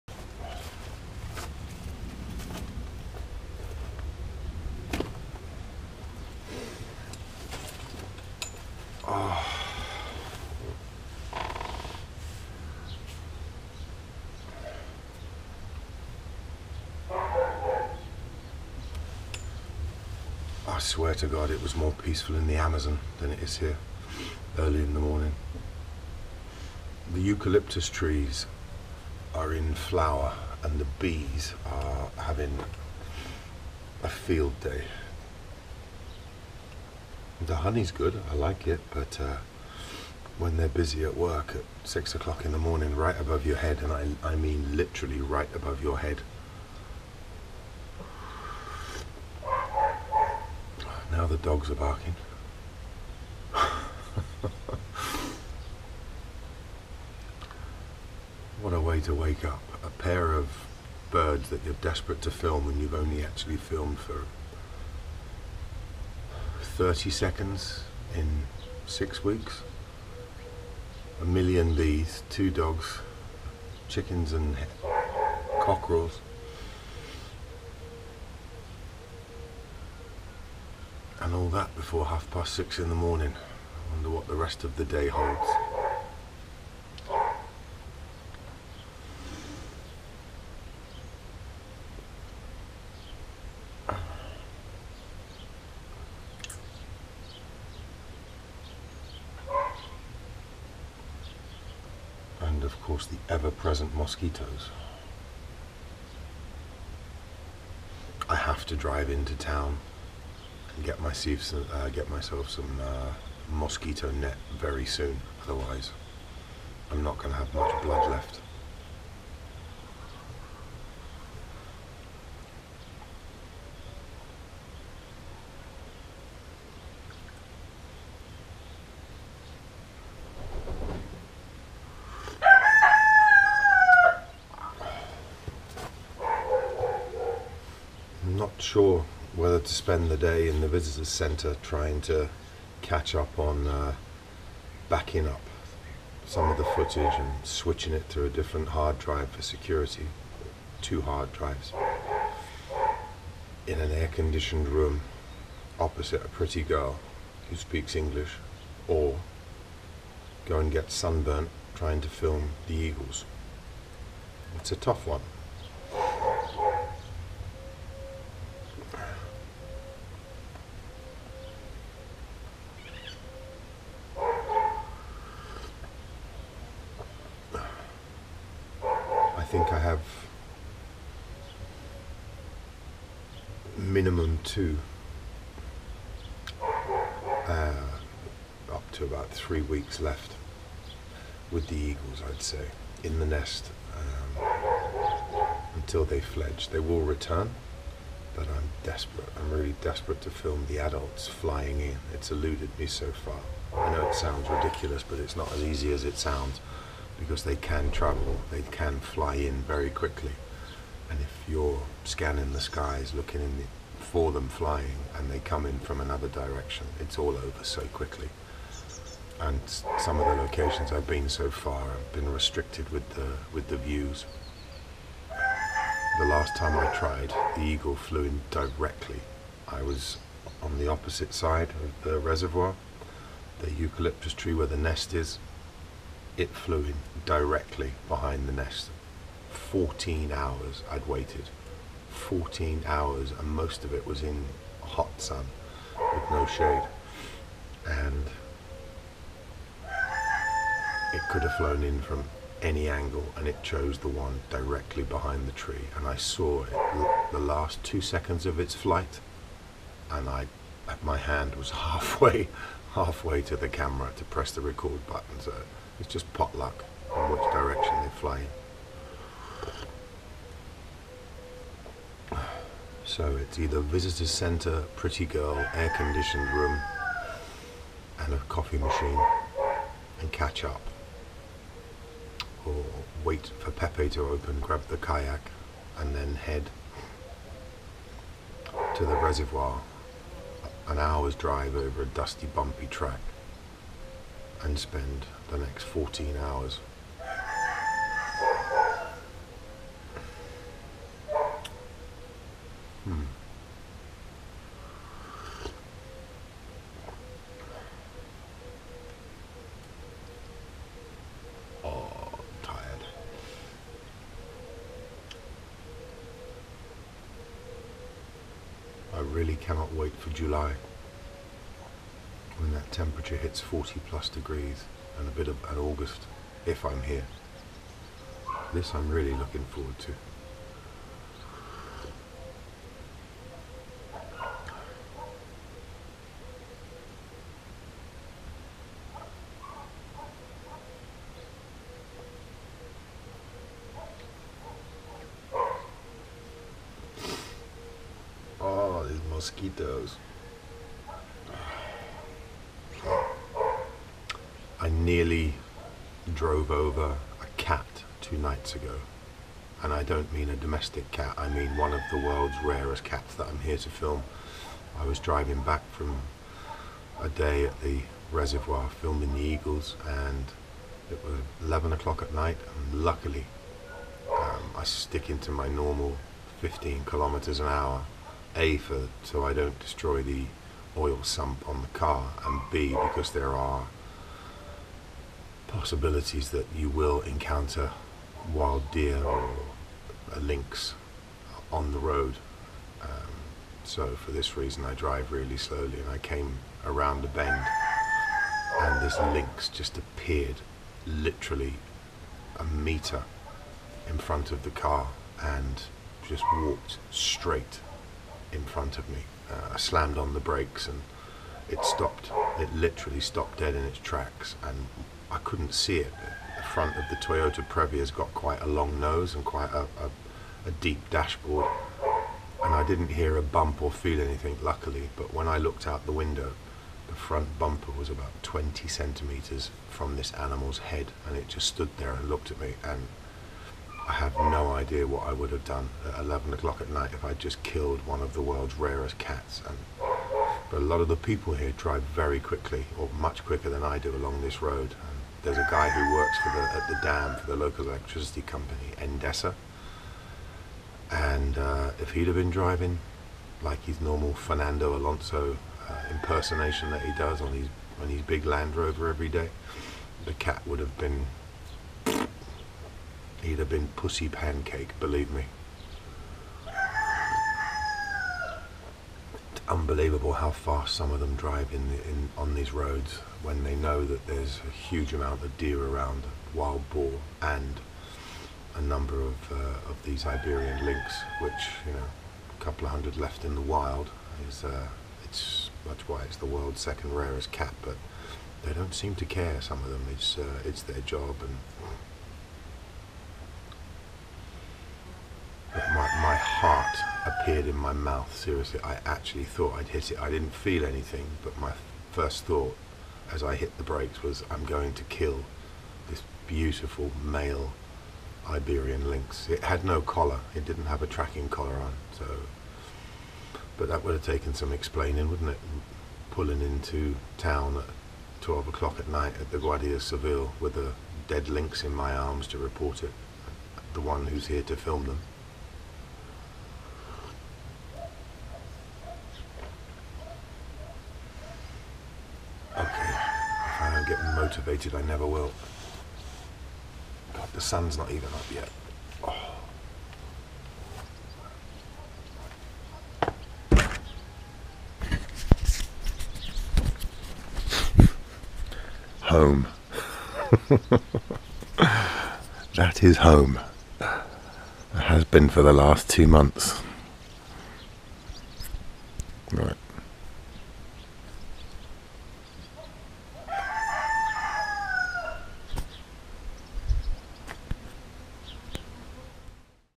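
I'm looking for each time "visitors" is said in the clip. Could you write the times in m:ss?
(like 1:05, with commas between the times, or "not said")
2:20, 4:33.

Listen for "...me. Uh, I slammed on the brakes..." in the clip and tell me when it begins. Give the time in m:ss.
6:49.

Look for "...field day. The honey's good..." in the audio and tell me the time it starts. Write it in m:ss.
0:34.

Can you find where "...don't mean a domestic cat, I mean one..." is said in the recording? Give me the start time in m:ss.
6:00.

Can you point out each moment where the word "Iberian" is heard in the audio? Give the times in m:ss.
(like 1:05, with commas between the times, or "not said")
8:00, 8:28.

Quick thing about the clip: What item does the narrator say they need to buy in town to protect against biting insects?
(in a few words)
mosquito net.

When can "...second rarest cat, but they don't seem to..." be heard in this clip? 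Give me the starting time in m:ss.
8:06.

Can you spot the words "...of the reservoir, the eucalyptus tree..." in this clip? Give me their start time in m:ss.
3:51.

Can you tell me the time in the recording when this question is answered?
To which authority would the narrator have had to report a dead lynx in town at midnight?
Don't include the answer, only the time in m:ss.
8:39.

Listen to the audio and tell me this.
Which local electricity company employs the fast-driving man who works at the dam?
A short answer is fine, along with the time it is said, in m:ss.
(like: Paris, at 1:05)
Endesa, at 7:28.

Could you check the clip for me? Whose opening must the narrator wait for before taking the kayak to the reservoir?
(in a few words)
Pepe.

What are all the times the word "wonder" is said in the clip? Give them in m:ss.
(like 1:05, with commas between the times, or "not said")
1:23.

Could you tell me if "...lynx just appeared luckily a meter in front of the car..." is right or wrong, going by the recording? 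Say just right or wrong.
wrong.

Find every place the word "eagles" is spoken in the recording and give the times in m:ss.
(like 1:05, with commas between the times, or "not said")
2:42, 3:11, 3:47, 6:09.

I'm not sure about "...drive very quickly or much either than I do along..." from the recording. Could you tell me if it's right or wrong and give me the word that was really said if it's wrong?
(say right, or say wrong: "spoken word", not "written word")
wrong: "quicker", not "either".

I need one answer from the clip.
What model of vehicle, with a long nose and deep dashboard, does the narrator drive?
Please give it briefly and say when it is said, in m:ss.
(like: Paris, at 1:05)
Toyota Previa, at 6:57.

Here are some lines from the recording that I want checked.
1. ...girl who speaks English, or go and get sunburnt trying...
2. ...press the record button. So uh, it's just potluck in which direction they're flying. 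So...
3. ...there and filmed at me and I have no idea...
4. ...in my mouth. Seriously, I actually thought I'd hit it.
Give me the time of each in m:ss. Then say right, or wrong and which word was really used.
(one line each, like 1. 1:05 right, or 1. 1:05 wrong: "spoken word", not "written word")
1. 2:36 right
2. 4:24 right
3. 7:11 wrong: "looked", not "filmed"
4. 8:17 right.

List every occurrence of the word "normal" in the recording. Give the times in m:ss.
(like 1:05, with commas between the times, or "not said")
6:15, 7:34.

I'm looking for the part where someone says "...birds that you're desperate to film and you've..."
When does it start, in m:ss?
1:01.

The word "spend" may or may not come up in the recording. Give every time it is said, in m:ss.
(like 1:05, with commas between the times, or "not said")
2:19, 4:54.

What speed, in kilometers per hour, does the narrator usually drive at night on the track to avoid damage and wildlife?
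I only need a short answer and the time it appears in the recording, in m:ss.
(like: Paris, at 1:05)
15, at 6:16.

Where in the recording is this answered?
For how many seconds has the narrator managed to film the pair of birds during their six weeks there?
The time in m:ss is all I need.
1:06.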